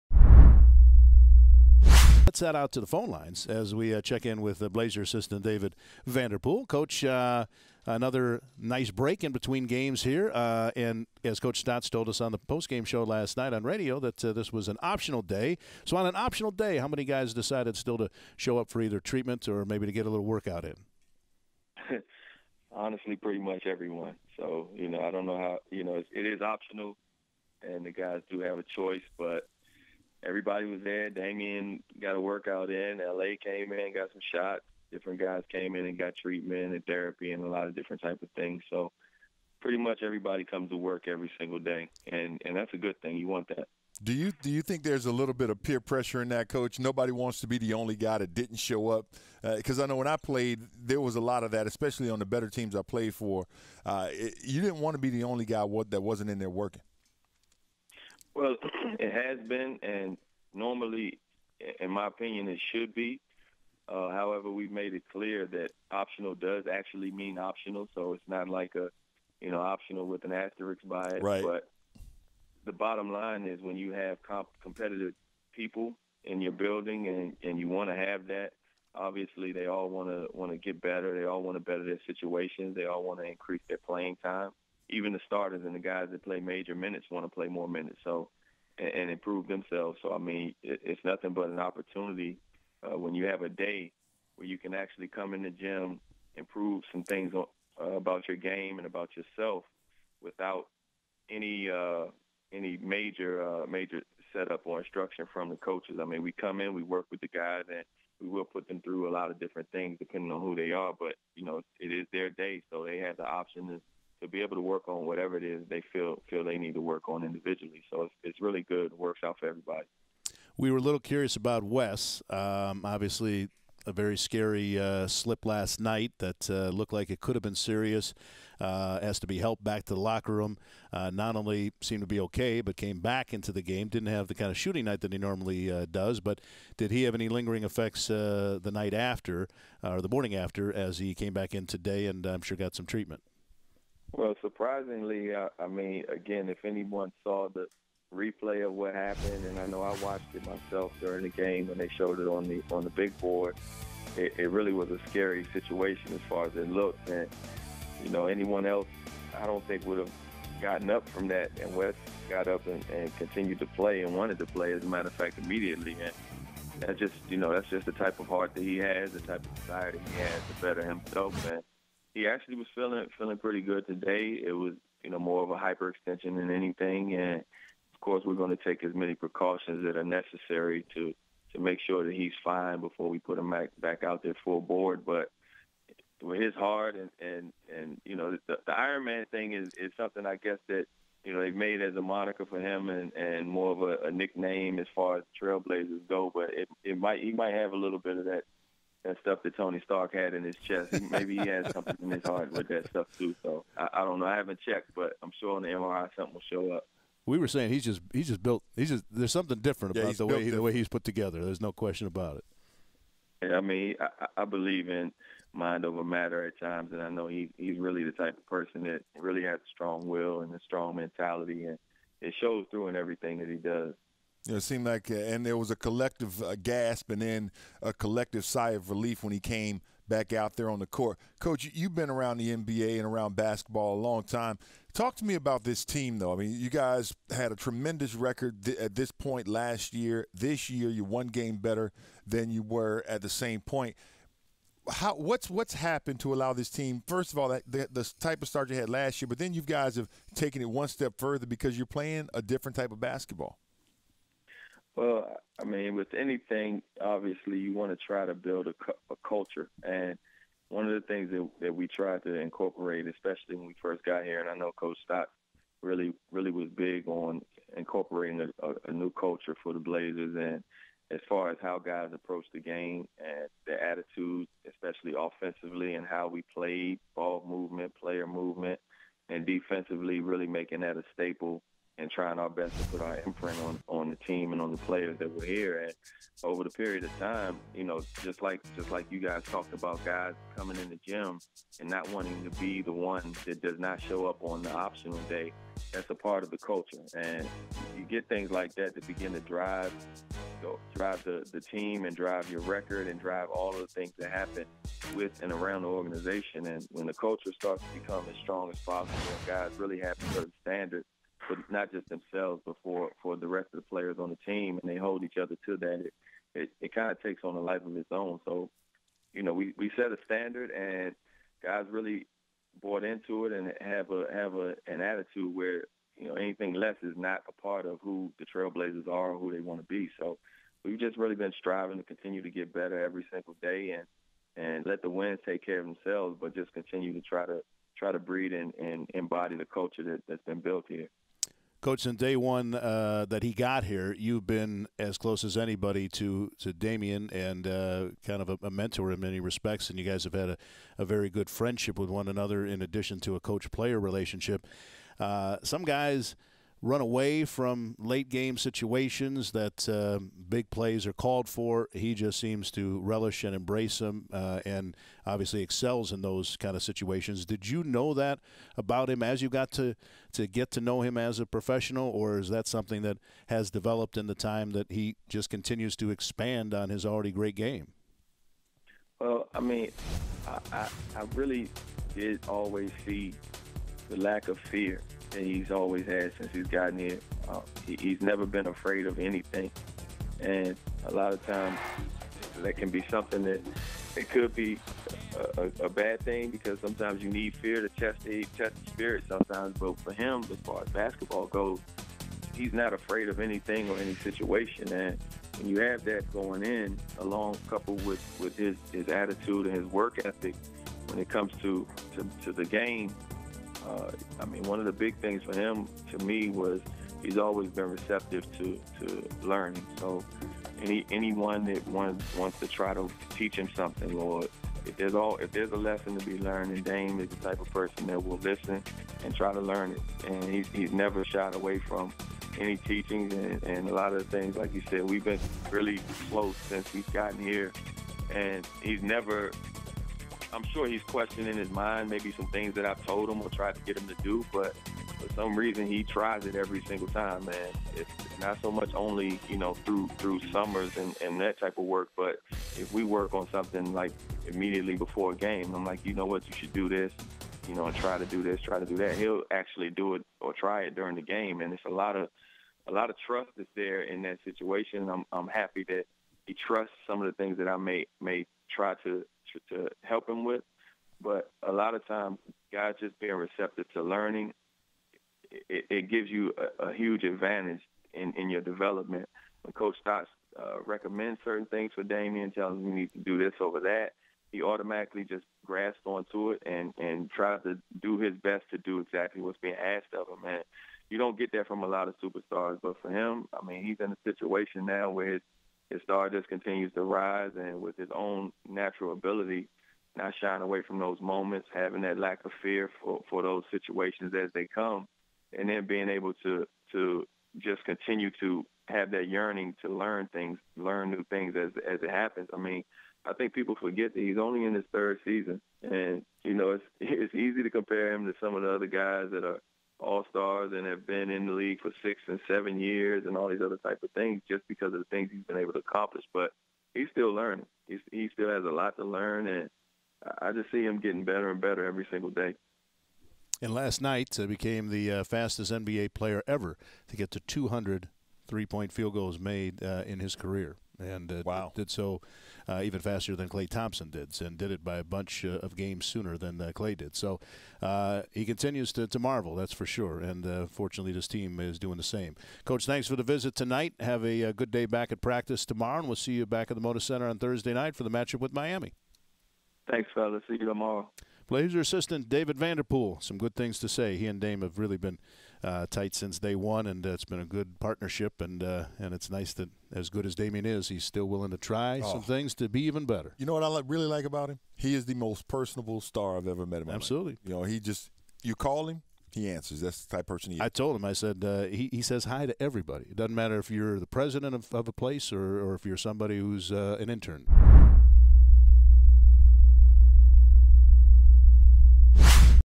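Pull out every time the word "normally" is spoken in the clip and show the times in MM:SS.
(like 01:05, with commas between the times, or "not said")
01:00, 02:15.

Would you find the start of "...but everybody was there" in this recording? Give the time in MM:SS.
00:29.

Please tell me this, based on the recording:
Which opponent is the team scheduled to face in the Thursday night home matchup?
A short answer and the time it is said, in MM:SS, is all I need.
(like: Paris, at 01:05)
Miami, at 09:18.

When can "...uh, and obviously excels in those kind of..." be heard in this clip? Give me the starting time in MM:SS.
06:04.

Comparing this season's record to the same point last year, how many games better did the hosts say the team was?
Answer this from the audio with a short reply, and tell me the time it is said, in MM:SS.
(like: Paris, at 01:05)
1, at 04:01.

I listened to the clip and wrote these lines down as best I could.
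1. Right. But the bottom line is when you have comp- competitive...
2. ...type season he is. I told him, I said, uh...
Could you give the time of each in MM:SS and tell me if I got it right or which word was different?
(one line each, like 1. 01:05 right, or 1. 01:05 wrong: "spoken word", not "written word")
1. 01:11 right
2. 09:40 wrong: "person", not "season".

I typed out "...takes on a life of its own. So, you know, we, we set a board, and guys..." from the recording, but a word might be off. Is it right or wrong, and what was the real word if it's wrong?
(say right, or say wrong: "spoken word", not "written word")
wrong: "standard", not "board".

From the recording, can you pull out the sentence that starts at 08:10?
And you don't get that from a lot of superstars.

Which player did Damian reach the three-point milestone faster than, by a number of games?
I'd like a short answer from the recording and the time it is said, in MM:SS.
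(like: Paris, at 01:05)
Klay Thompson, at 09:03.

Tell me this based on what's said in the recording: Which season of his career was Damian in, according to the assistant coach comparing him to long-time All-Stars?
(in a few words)
Third.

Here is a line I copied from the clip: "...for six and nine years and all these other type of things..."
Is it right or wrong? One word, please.
wrong.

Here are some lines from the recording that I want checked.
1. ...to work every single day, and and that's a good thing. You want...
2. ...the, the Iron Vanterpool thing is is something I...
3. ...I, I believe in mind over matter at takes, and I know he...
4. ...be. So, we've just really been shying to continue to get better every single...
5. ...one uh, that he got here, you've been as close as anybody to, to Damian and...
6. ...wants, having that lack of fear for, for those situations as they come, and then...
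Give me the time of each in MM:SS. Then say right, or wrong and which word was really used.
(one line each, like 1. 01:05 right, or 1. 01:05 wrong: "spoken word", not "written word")
1. 00:40 right
2. 03:08 wrong: "Man", not "Vanterpool"
3. 03:33 wrong: "times", not "takes"
4. 05:29 wrong: "striving", not "shying"
5. 05:42 right
6. 08:21 wrong: "moments", not "wants".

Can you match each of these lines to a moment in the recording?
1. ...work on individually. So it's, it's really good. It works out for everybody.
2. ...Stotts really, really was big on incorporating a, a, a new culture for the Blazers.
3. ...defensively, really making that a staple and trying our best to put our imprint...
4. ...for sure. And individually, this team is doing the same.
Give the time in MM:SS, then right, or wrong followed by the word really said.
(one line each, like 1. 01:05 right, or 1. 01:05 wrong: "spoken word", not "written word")
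1. 01:56 right
2. 04:25 right
3. 04:39 right
4. 09:09 wrong: "fortunately", not "individually".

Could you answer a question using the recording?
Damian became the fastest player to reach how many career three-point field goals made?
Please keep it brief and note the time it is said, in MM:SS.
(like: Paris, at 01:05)
200, at 08:57.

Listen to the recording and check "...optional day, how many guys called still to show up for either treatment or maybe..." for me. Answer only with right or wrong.
wrong.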